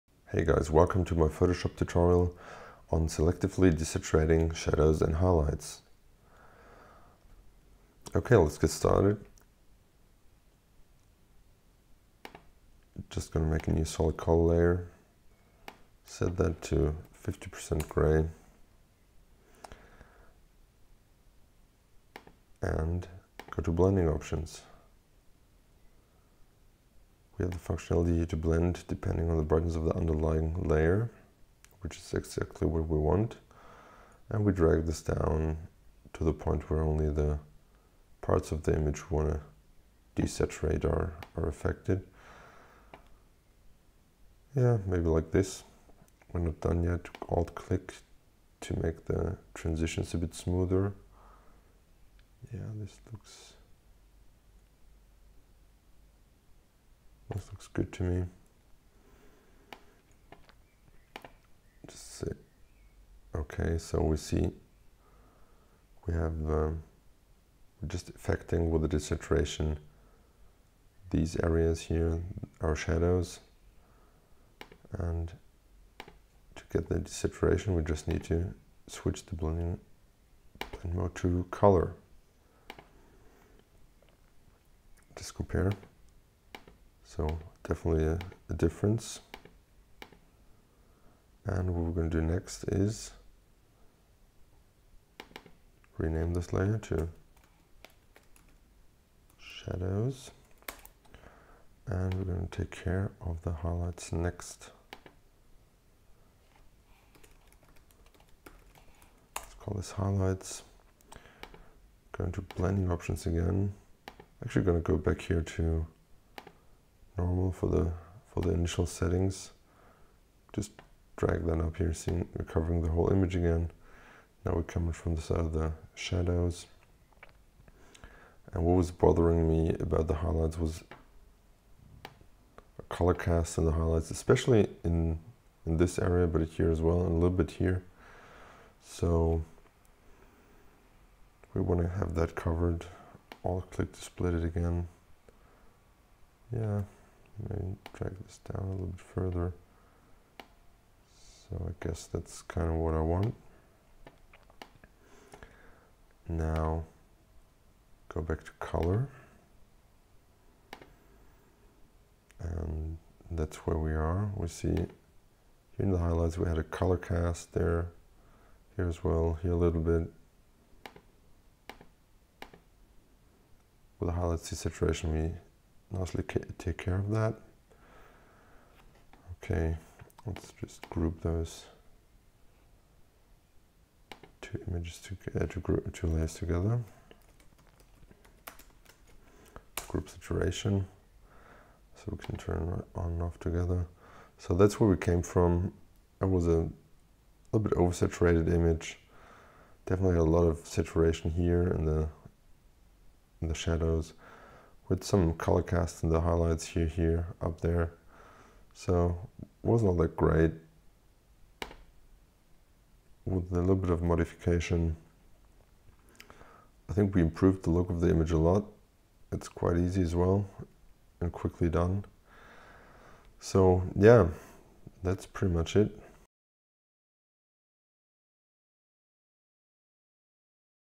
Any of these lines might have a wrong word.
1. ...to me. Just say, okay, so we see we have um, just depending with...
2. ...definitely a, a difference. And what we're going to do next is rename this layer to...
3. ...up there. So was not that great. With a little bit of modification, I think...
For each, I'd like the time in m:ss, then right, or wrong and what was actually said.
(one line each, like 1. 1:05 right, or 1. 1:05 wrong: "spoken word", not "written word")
1. 0:57 wrong: "affecting", not "depending"
2. 1:27 right
3. 3:27 right.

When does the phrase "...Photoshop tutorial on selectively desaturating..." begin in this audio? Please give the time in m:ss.
0:01.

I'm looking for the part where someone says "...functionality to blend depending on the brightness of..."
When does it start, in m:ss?
0:27.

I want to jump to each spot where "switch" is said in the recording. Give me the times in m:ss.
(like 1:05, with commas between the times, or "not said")
1:18.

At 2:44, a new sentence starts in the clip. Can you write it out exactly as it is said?
We see here in the highlights we had a color cast there, here as well, here a little bit.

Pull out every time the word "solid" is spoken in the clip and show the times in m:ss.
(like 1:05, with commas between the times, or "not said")
0:13.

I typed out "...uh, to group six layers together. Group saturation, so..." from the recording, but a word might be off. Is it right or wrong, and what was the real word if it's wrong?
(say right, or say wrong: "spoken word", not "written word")
wrong: "two", not "six".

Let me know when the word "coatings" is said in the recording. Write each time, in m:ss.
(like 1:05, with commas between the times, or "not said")
not said.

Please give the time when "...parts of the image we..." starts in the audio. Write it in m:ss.
0:38.